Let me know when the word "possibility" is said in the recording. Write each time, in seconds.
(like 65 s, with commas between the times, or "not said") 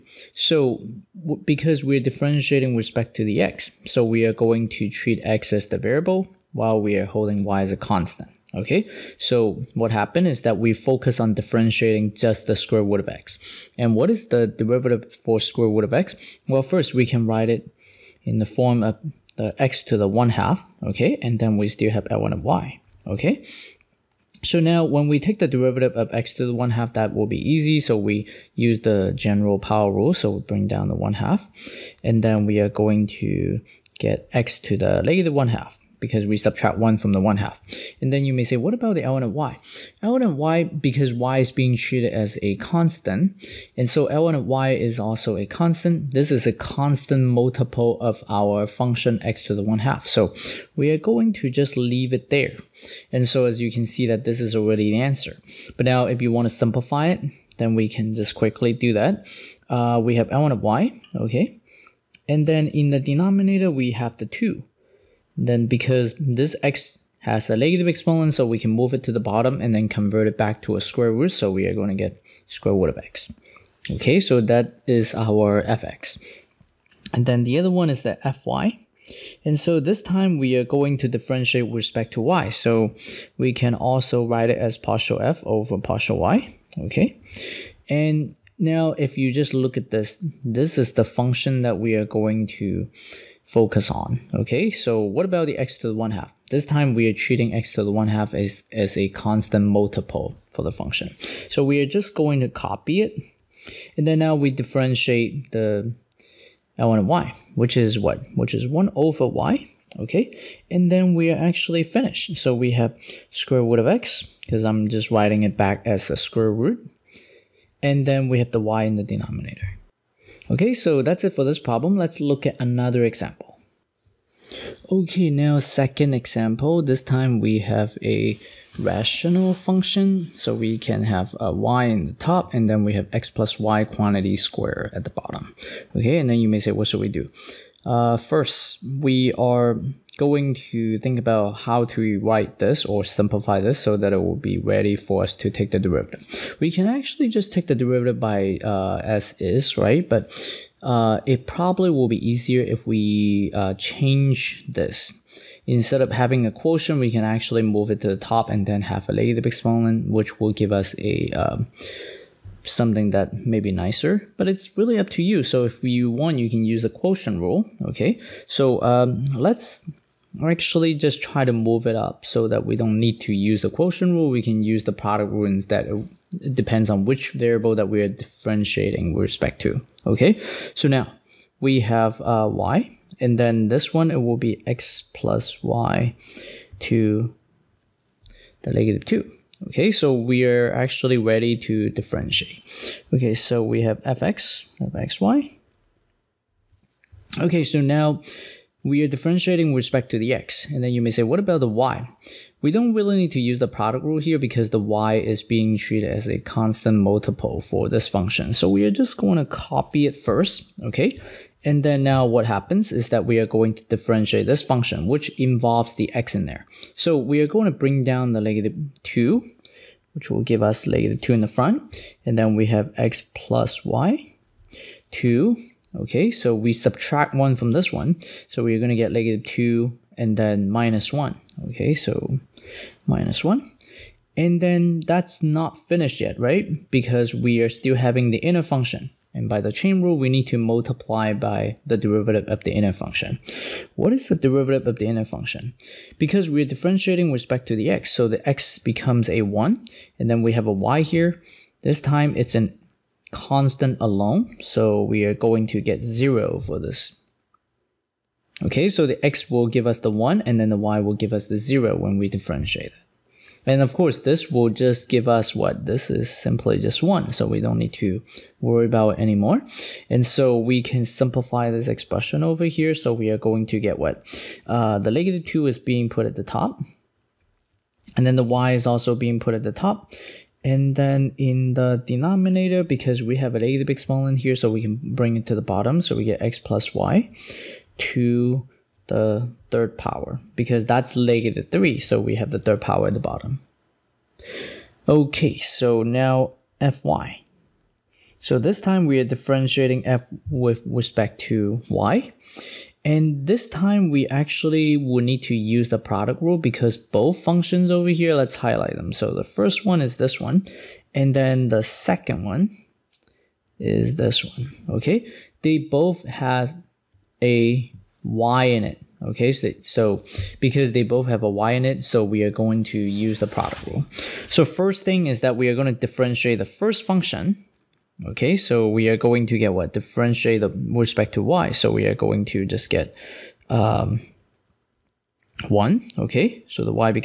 not said.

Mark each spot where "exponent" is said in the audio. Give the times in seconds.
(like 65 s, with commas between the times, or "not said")
67 s, 159 s.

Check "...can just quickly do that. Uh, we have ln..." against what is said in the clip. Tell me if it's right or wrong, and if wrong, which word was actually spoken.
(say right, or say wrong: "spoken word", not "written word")
right.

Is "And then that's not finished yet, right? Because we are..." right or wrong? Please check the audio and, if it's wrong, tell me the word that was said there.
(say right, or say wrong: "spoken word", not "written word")
right.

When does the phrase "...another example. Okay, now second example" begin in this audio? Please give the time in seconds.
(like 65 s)
122 s.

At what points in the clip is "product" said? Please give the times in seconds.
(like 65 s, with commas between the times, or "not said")
174 s, 203 s, 305 s, 323 s.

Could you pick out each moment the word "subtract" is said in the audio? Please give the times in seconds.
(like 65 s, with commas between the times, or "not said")
36 s, 226 s.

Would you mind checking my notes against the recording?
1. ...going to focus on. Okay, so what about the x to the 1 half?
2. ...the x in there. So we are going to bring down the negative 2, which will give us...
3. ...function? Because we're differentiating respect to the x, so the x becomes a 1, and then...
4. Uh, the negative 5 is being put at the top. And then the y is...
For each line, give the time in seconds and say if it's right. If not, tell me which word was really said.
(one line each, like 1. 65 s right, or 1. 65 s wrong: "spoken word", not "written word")
1. 92 s right
2. 215 s right
3. 245 s right
4. 274 s wrong: "2", not "5".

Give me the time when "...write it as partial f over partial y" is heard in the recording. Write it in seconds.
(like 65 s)
84 s.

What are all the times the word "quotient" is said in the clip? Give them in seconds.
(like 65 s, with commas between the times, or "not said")
156 s, 166 s, 173 s.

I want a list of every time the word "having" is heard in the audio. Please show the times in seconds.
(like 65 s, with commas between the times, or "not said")
156 s, 237 s.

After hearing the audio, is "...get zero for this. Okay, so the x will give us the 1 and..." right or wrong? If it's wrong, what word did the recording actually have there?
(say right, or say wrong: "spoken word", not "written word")
right.